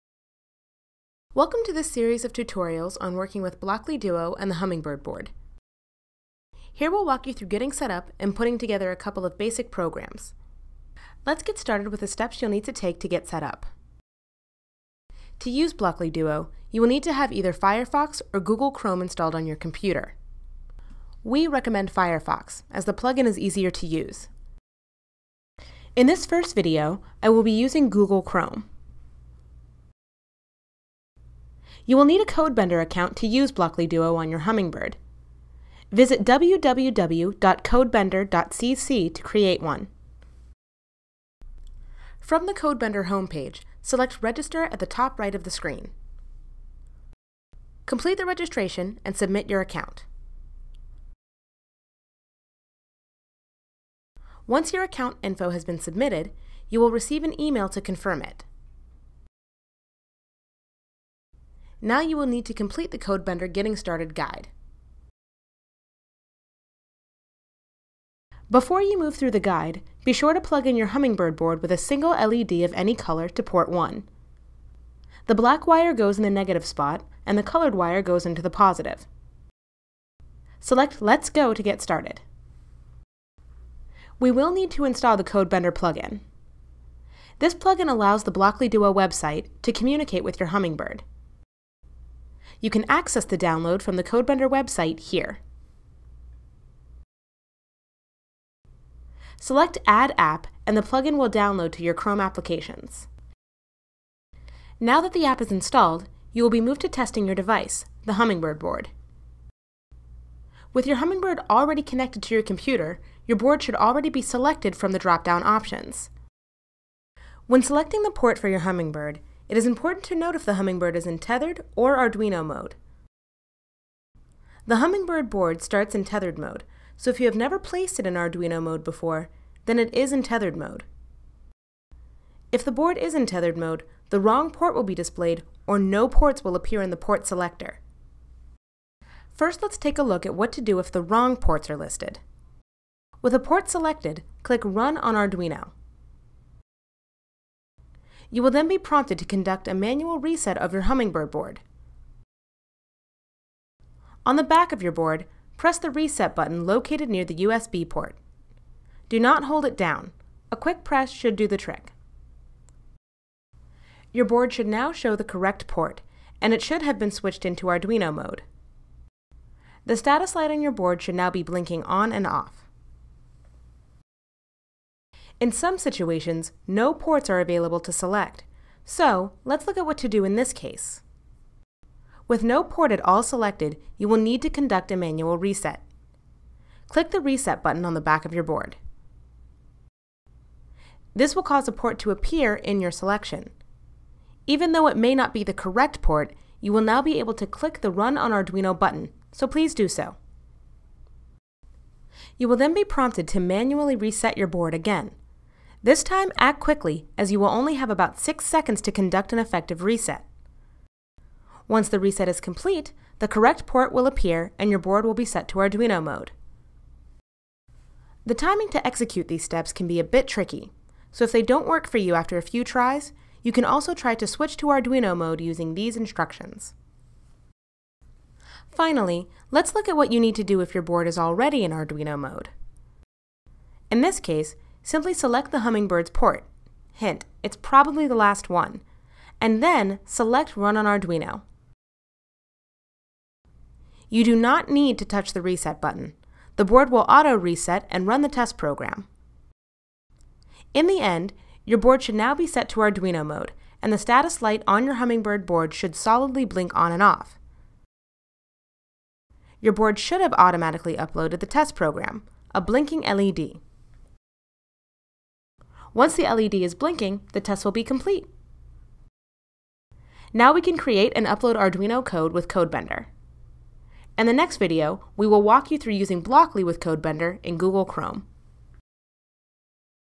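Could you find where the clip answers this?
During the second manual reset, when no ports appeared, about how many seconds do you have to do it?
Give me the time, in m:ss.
3:27.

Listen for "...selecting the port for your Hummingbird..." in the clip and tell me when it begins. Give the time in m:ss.
1:57.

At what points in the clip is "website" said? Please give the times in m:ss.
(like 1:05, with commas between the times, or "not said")
1:28, 1:34.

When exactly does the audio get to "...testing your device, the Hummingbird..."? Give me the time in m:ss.
1:46.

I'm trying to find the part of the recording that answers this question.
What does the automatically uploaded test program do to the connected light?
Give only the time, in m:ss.
4:22.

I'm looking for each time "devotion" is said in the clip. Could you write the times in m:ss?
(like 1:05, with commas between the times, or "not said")
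not said.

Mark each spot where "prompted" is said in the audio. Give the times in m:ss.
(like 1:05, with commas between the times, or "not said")
2:28, 3:22.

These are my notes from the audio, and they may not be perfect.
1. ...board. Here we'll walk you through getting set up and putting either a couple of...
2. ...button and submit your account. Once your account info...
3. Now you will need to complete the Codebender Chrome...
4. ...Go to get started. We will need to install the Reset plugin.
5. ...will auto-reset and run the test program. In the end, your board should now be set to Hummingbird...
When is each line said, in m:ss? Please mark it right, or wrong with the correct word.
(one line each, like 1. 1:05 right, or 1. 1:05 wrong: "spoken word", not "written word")
1. 0:05 wrong: "together", not "either"
2. 0:48 wrong: "registration", not "button"
3. 1:01 wrong: "Getting", not "Chrome"
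4. 1:21 wrong: "Codebender", not "Reset"
5. 4:06 wrong: "Arduino", not "Hummingbird".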